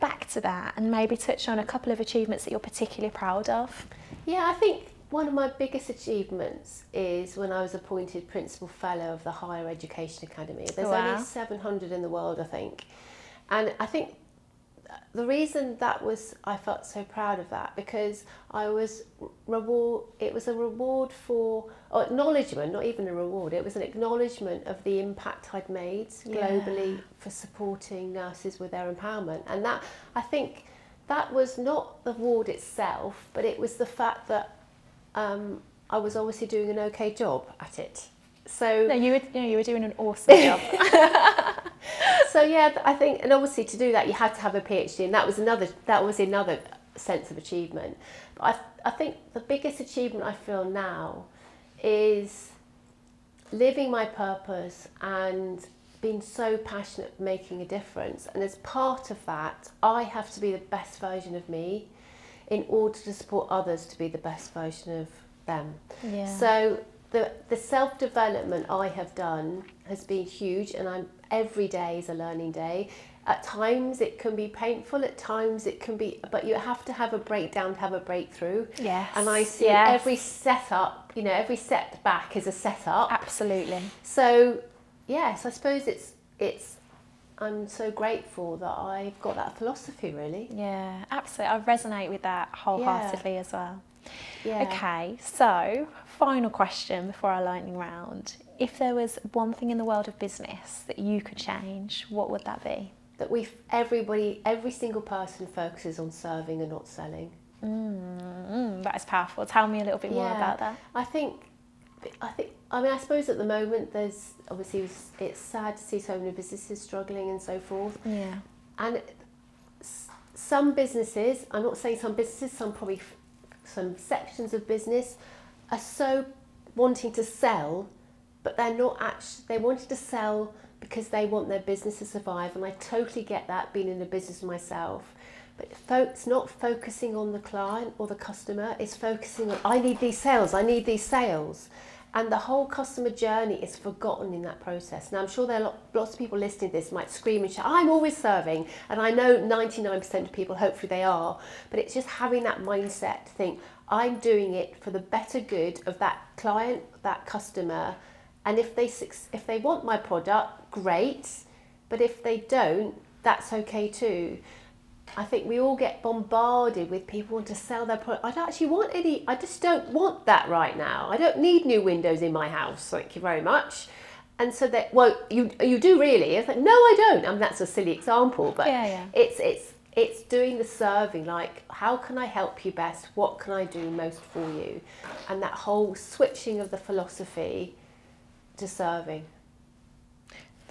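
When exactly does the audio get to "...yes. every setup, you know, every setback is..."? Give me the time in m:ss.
1:19.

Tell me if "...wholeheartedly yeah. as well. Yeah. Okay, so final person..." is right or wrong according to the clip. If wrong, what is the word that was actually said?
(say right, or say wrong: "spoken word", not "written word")
wrong: "question", not "person".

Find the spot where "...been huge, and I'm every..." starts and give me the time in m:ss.
1:10.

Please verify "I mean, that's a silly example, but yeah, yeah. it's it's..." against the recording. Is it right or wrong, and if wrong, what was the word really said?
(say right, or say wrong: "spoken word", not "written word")
right.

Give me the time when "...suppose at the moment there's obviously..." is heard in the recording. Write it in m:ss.
1:52.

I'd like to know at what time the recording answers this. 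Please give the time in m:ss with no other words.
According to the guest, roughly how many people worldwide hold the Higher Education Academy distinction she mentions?
0:11.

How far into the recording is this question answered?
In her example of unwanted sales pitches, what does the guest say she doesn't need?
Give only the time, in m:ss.
2:51.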